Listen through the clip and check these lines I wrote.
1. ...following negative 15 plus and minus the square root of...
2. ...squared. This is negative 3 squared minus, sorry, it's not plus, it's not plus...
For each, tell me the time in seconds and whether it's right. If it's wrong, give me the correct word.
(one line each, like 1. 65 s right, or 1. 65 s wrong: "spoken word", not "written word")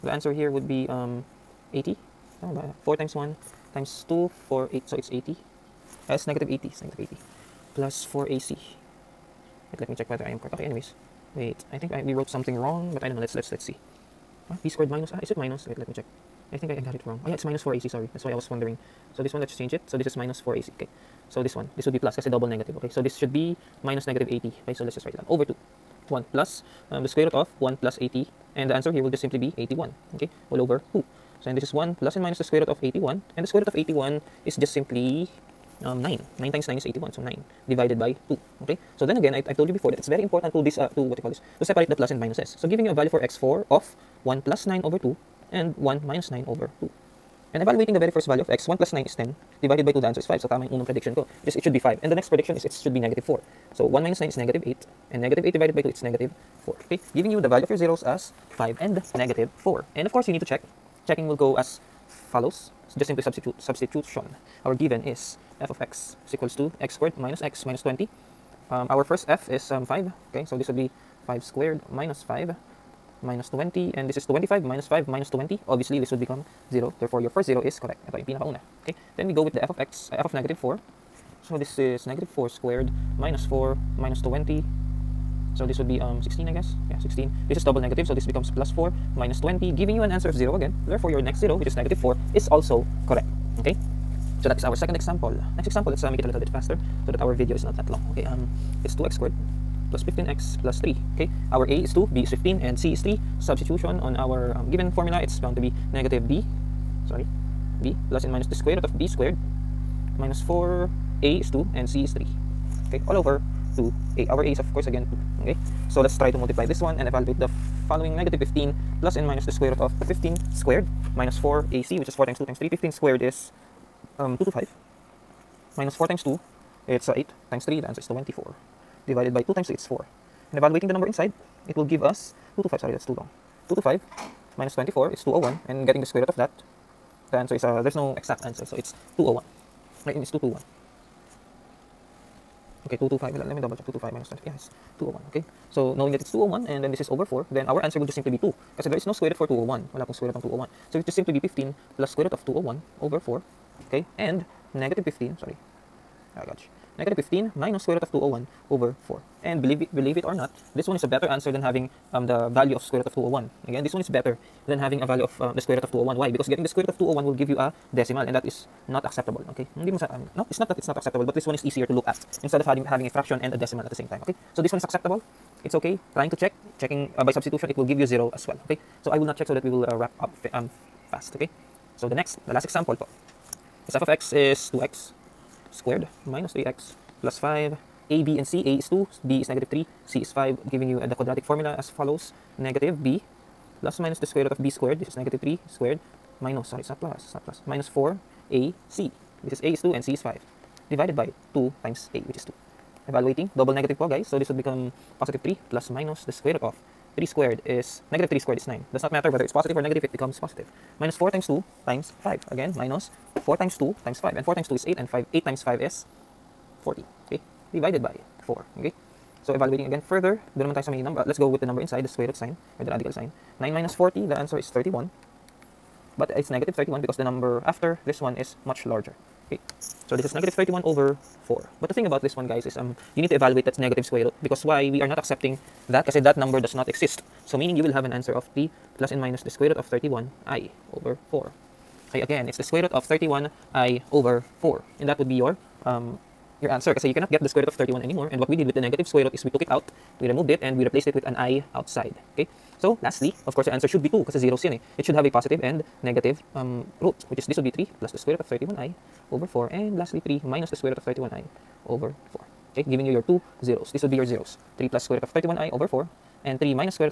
1. 117 s right
2. 194 s right.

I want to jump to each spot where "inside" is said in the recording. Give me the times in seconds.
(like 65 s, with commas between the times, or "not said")
131 s, 221 s.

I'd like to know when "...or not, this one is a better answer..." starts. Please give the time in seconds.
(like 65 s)
160 s.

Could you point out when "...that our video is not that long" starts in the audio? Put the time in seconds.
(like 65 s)
97 s.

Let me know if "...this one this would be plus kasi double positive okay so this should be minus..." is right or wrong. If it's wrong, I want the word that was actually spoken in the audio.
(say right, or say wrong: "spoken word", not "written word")
wrong: "negative", not "positive".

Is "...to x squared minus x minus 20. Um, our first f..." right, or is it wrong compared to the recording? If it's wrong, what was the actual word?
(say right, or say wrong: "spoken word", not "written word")
right.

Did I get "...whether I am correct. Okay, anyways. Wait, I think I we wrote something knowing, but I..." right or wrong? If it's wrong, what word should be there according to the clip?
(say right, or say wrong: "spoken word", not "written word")
wrong: "wrong", not "knowing".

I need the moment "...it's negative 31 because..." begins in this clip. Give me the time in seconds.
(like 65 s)
226 s.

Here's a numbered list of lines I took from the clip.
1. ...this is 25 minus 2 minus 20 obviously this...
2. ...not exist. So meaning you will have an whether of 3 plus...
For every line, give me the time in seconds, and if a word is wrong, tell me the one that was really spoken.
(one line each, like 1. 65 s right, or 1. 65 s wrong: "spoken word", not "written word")
1. 74 s wrong: "5", not "2"
2. 236 s wrong: "answer", not "whether".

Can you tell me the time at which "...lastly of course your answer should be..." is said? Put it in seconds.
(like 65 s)
253 s.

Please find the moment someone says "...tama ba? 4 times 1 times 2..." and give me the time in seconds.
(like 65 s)
2 s.